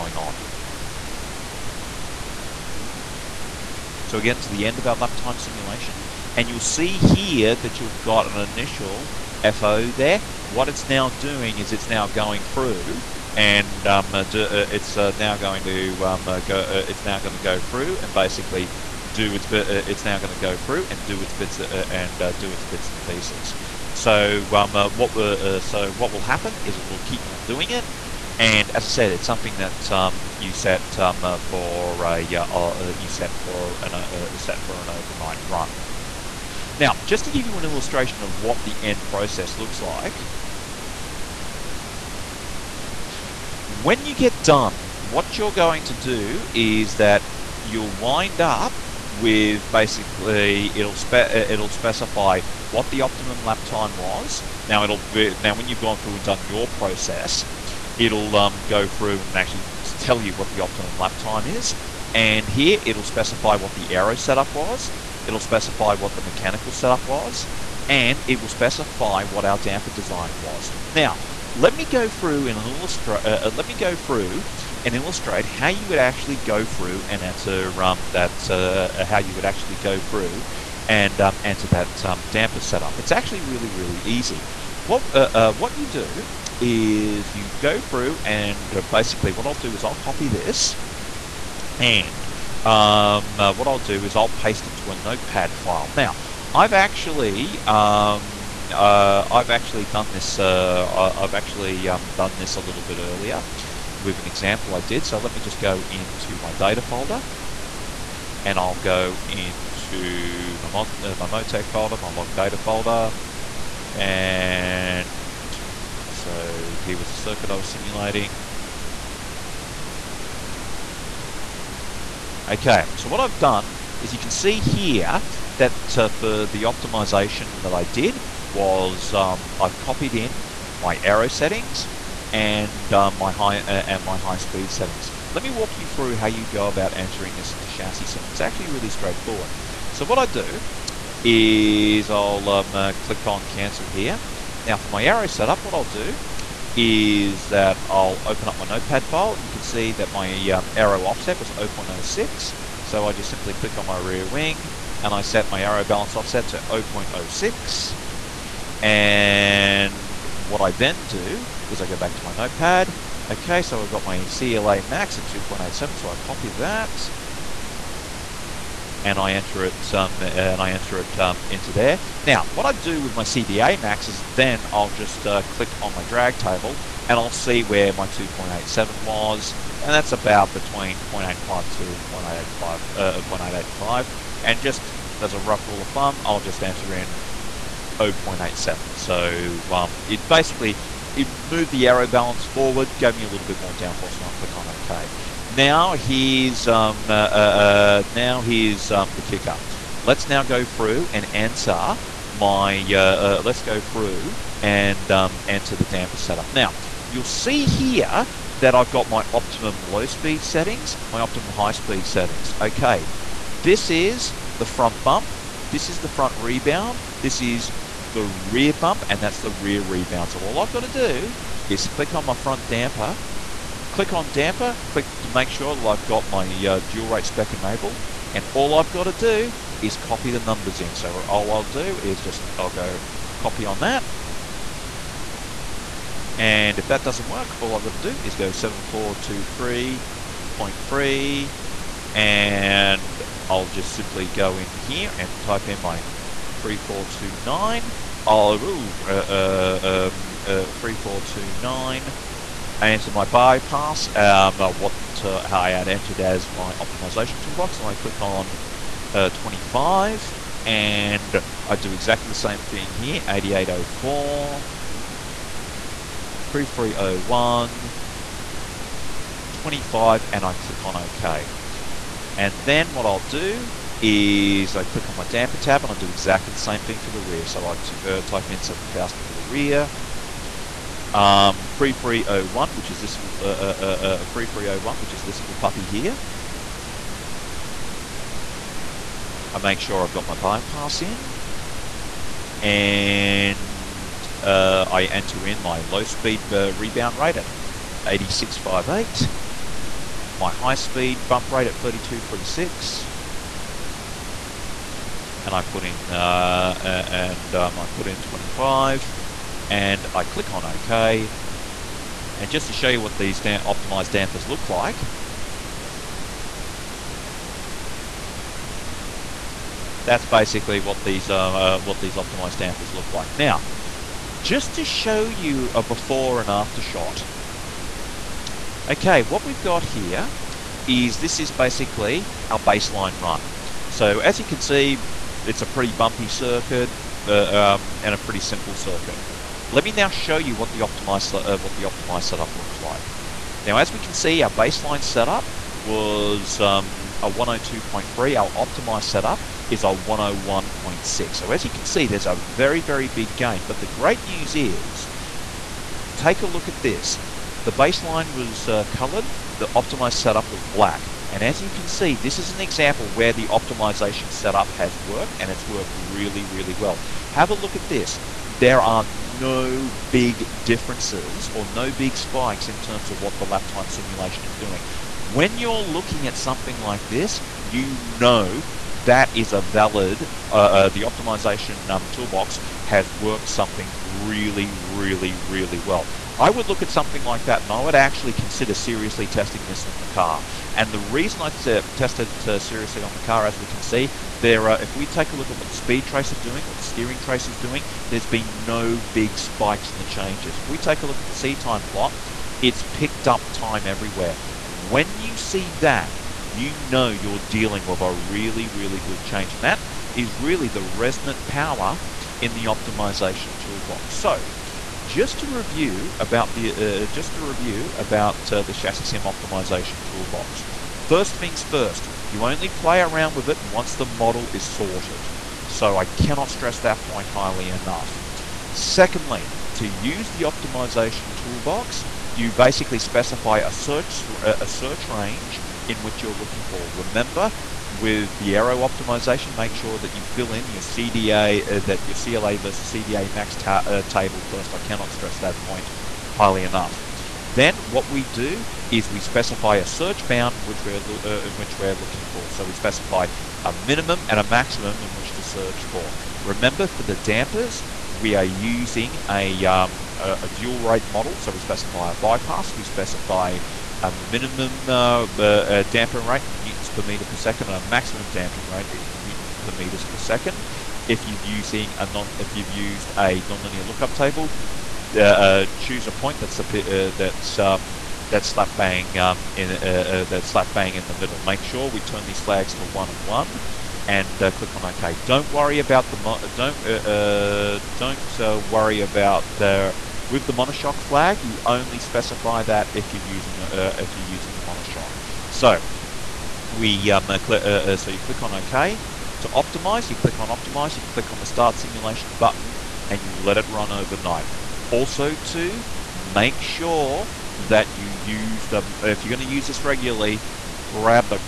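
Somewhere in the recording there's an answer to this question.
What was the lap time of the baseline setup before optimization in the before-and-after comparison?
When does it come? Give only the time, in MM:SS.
05:47.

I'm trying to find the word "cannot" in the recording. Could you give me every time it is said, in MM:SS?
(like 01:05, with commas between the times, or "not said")
07:06, 07:24.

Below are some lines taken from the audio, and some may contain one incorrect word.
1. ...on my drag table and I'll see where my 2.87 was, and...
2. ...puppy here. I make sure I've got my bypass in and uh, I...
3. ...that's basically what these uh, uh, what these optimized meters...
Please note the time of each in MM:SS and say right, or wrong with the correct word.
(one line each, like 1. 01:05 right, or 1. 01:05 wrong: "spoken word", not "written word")
1. 02:55 right
2. 04:45 right
3. 05:20 wrong: "dampers", not "meters".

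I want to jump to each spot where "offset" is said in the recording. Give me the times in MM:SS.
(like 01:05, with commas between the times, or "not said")
02:31, 02:36.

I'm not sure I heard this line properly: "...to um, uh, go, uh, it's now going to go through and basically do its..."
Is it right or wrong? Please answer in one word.
right.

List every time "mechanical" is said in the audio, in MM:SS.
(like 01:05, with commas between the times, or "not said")
01:06.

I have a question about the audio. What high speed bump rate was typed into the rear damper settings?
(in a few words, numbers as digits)
32.36.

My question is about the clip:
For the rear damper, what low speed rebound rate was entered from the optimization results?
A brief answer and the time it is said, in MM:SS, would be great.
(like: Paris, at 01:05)
86.58, at 04:58.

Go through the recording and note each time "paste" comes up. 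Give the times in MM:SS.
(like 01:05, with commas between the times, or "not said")
01:34.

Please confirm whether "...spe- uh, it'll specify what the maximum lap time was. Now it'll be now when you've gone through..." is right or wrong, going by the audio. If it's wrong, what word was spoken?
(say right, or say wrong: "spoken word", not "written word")
wrong: "optimum", not "maximum".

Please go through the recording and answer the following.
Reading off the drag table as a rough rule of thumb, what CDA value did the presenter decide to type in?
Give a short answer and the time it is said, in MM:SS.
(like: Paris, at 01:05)
0.87, at 03:08.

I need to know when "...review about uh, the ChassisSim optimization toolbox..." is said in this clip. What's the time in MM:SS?
06:57.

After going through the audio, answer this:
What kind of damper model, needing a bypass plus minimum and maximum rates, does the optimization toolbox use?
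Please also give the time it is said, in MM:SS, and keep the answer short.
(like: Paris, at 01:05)
dual rate model, at 07:40.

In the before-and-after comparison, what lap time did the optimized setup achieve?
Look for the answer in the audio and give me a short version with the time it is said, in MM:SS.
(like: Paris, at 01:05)
101.6, at 05:49.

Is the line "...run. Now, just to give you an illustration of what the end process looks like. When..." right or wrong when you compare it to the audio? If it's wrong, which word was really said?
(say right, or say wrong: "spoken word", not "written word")
right.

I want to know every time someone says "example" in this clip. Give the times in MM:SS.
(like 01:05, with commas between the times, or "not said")
01:44, 06:02.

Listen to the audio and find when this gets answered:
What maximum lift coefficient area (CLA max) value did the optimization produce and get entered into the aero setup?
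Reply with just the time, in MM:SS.
02:44.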